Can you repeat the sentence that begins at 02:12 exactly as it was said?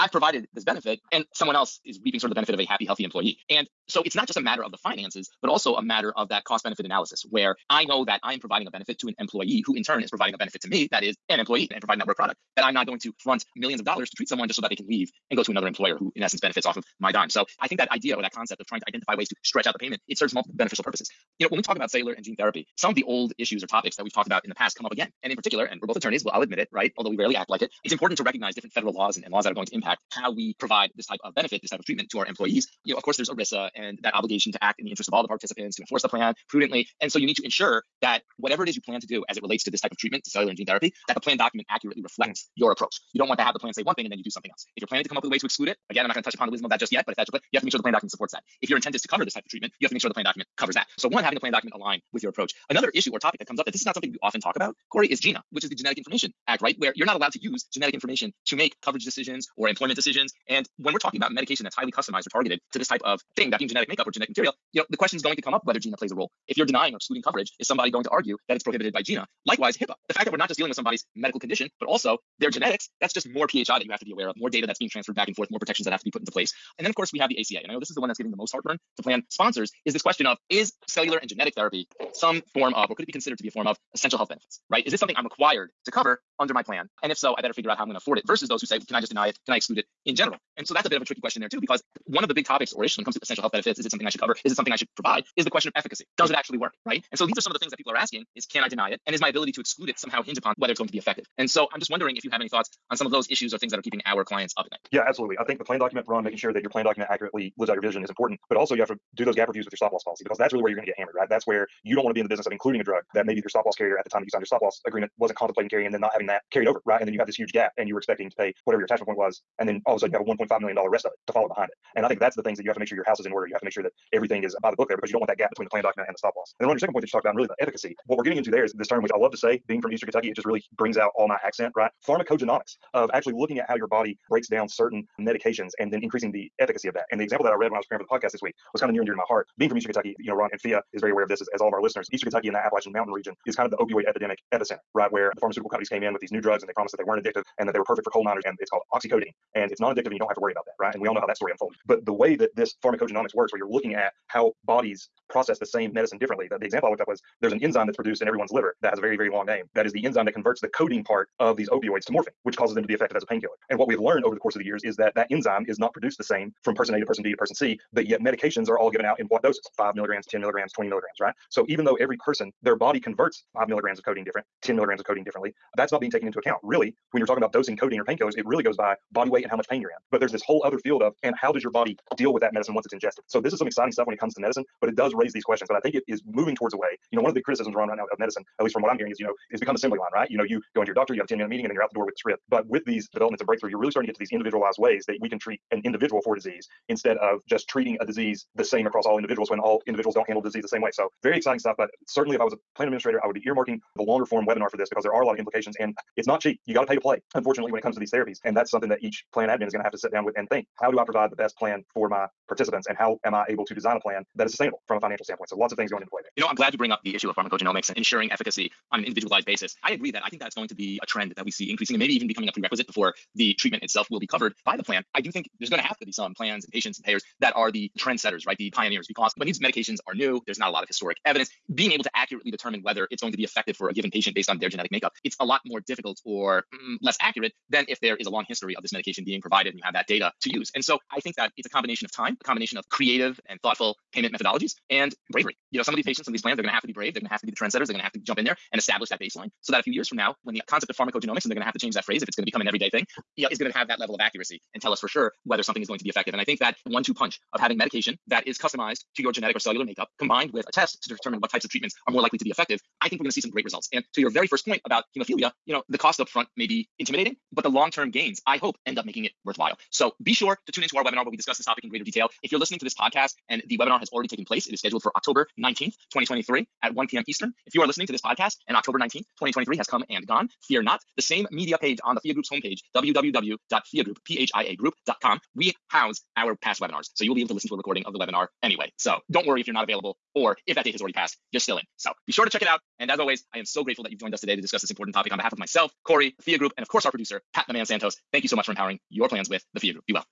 Pharmacogenomics of actually looking at how your body breaks down certain medications and then increasing the efficacy of that.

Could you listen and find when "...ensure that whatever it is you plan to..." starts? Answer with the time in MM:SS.
00:37.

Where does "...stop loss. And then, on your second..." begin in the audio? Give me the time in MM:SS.
02:06.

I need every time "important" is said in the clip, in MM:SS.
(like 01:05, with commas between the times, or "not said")
00:27, 01:48, 04:54.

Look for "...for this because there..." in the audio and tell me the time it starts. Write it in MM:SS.
03:24.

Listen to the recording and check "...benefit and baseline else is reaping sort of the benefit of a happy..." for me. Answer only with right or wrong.
wrong.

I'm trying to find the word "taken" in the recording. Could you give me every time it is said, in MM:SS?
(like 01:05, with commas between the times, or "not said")
02:56, 04:34.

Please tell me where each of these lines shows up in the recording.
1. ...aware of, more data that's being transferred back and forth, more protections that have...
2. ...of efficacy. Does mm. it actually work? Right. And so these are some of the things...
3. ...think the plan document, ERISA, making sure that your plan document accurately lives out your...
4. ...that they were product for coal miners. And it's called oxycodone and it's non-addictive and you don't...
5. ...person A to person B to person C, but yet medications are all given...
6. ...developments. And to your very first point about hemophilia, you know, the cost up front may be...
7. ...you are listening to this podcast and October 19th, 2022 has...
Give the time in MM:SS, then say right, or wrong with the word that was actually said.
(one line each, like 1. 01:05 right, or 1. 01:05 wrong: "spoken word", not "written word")
1. 01:14 right
2. 01:35 right
3. 01:45 wrong: "Ron", not "ERISA"
4. 02:27 wrong: "perfect", not "product"
5. 02:46 right
6. 04:23 wrong: "results", not "developments"
7. 04:37 wrong: "2023", not "2022".